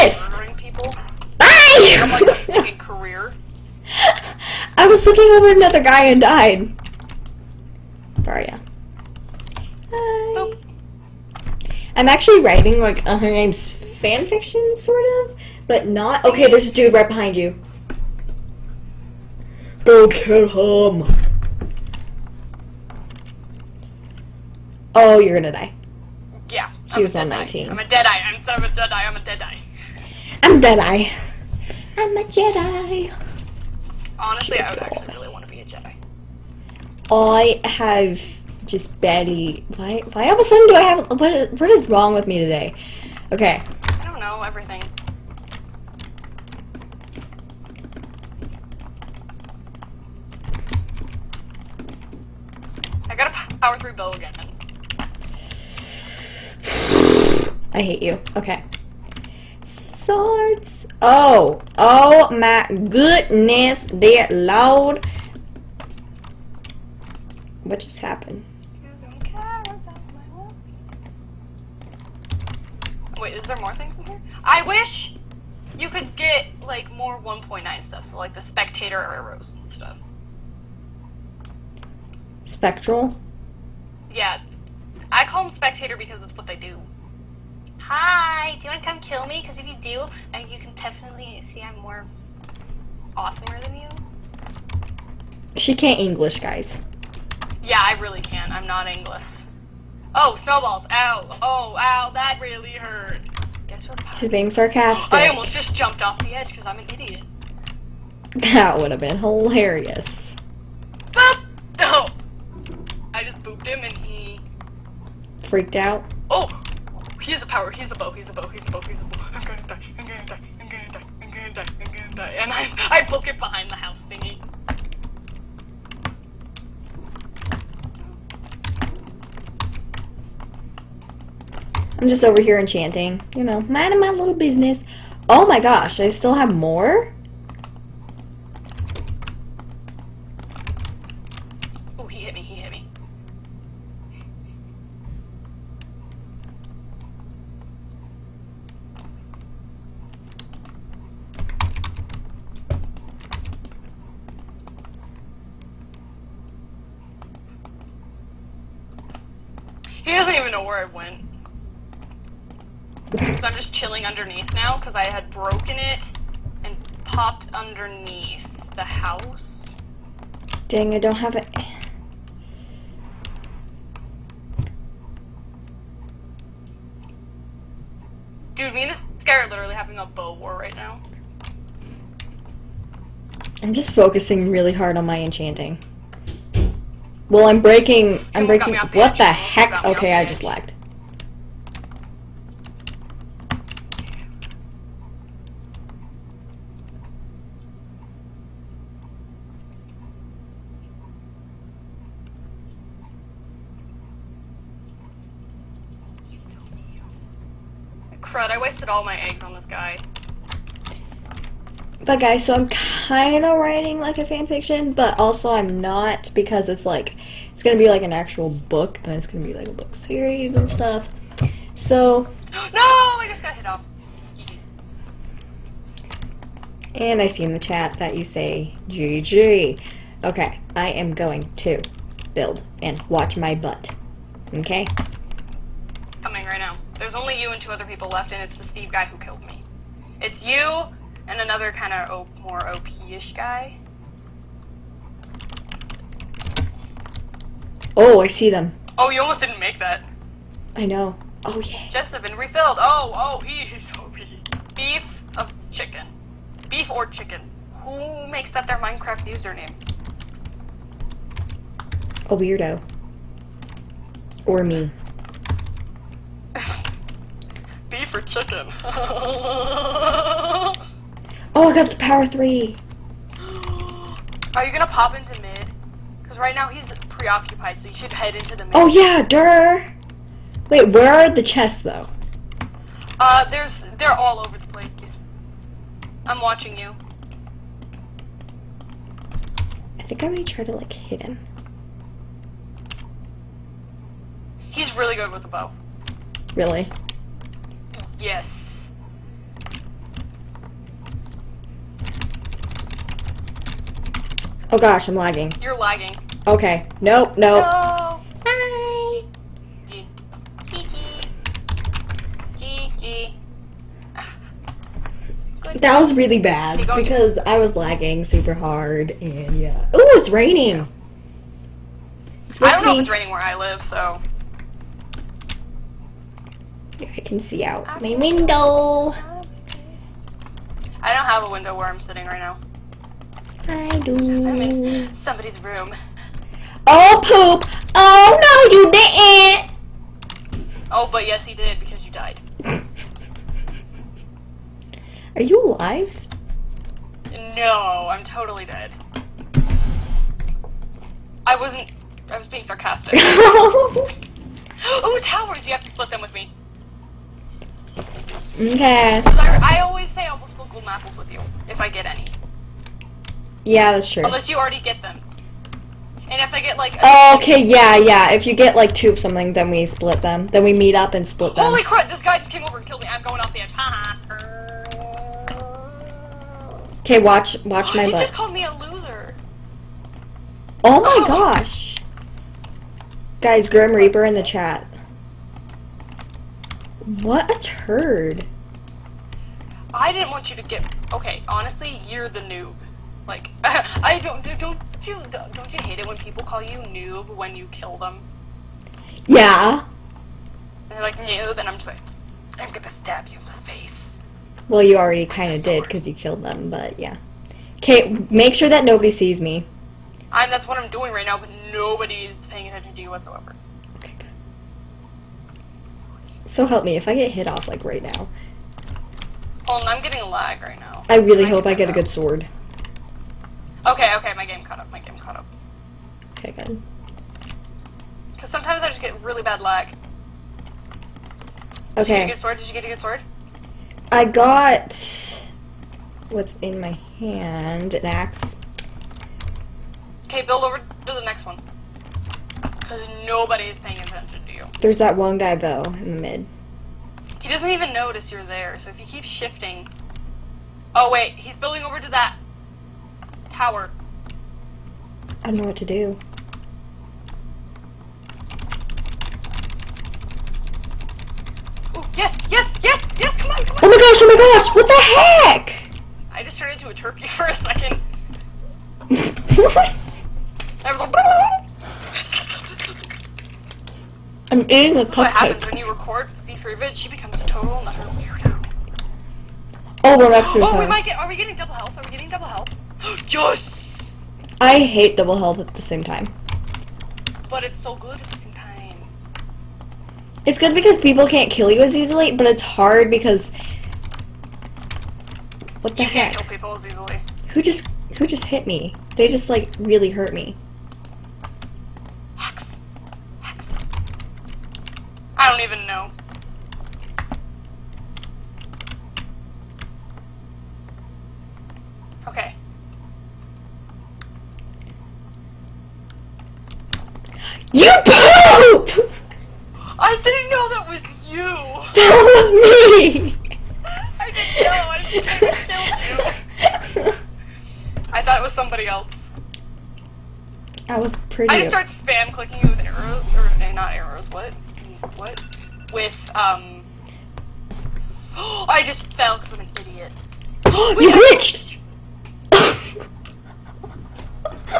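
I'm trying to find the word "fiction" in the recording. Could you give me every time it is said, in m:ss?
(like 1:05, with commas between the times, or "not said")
0:14, 3:34.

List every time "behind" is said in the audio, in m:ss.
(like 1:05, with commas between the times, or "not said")
0:17, 2:03.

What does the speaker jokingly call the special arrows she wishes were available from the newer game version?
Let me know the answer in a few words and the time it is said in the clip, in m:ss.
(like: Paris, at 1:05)
spectator arrows, at 1:18.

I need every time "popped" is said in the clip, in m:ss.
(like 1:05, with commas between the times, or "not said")
2:47.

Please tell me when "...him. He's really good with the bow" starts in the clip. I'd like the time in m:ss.
4:51.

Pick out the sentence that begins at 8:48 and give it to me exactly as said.
I thought it was somebody else.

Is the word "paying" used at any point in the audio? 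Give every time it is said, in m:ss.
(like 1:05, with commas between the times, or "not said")
6:52, 7:23.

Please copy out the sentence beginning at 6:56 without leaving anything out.
So help me, if I get hit off, like, right now.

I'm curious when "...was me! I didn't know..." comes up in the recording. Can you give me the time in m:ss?
8:42.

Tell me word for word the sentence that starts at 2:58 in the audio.
Dude, me and this guy are literally having a bow war right now.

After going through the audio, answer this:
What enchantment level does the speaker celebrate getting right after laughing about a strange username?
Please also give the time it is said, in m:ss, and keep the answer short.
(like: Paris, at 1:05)
power three, at 4:31.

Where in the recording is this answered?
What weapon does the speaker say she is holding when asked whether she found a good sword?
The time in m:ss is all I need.
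7:17.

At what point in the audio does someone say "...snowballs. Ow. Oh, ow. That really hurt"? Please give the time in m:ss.
1:40.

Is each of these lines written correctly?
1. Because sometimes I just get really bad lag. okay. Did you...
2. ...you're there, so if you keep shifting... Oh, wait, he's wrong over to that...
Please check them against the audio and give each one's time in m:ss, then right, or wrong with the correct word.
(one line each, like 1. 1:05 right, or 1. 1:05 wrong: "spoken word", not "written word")
1. 7:08 right
2. 7:28 wrong: "building", not "wrong".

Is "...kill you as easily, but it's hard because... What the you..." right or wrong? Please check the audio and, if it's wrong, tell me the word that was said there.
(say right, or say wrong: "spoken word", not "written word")
right.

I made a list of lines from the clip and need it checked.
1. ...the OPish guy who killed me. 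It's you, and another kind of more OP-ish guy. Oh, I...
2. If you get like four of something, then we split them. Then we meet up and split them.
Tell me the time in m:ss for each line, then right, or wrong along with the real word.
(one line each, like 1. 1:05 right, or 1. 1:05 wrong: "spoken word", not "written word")
1. 3:58 wrong: "Steve", not "OPish"
2. 6:08 wrong: "two", not "four".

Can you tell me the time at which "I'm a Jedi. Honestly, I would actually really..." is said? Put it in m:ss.
0:31.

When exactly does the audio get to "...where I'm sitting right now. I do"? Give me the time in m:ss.
5:31.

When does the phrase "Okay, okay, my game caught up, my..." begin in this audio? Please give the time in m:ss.
7:03.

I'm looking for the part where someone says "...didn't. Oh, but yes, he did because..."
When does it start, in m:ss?
5:38.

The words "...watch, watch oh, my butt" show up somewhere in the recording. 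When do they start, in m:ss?
6:17.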